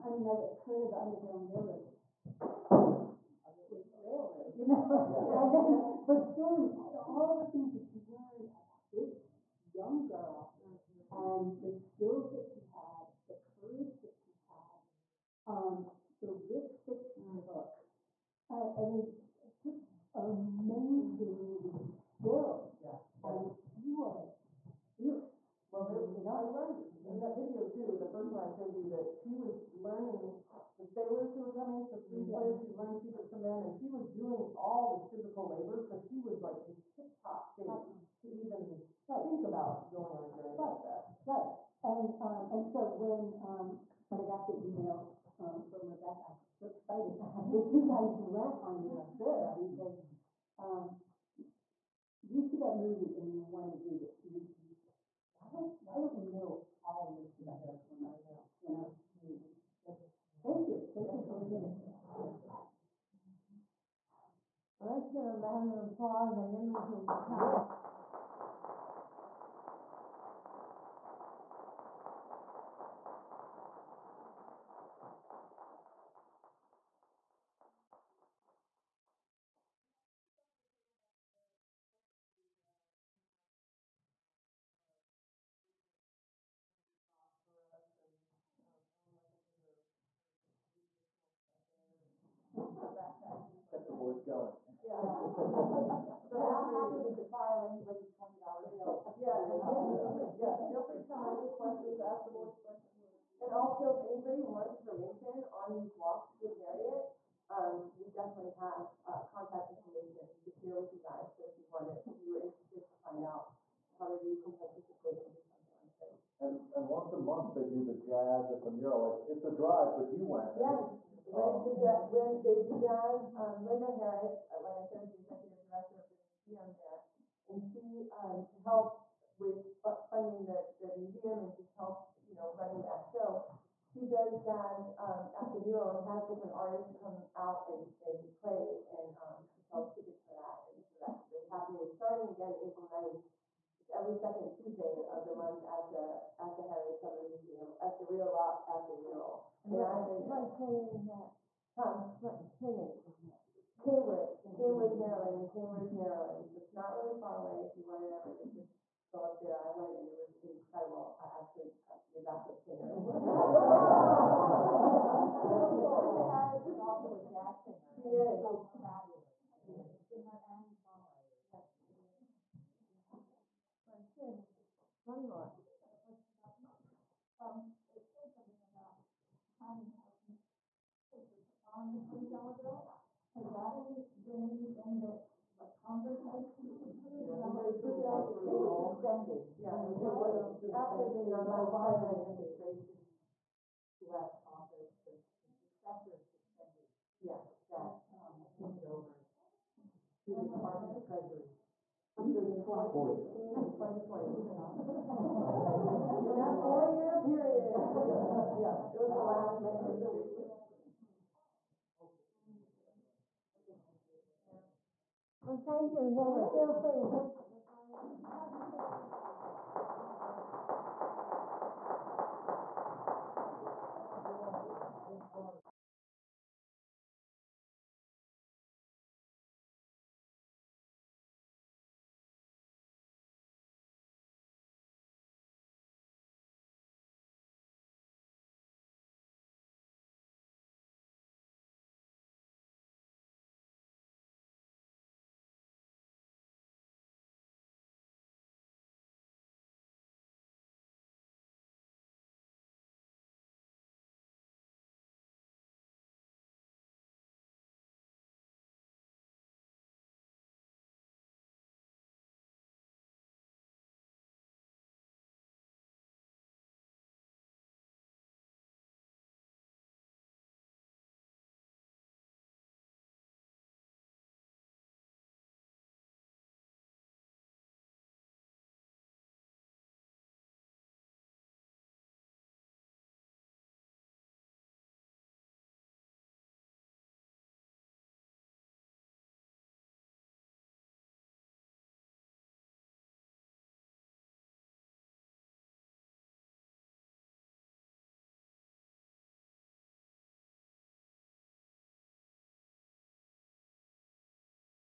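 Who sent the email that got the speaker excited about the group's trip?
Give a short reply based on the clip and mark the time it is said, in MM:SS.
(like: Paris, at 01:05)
Rebecca, at 00:45.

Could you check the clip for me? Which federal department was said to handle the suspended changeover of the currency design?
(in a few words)
Department of Treasury.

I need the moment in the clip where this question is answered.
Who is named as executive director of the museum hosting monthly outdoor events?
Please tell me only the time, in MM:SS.
02:03.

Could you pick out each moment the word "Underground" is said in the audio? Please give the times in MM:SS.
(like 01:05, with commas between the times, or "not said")
00:01.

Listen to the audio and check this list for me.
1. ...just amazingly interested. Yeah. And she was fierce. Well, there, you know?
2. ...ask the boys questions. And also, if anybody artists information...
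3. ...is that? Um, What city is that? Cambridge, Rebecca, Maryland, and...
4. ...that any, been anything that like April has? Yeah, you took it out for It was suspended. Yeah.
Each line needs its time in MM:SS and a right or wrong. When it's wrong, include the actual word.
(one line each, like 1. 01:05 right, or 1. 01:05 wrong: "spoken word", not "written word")
1. 00:19 wrong: "skilled", not "interested"
2. 01:42 wrong: "wants", not "artists"
3. 02:30 wrong: "Cambridge", not "Rebecca"
4. 03:03 wrong: "Congress", not "April".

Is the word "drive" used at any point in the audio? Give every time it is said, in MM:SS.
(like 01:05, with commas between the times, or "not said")
01:59.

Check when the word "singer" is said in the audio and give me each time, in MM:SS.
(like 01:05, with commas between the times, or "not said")
02:42, 02:47.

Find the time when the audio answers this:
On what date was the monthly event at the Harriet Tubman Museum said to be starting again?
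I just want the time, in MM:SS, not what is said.
02:22.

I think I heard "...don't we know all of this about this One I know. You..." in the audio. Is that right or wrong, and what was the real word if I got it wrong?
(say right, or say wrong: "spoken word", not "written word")
right.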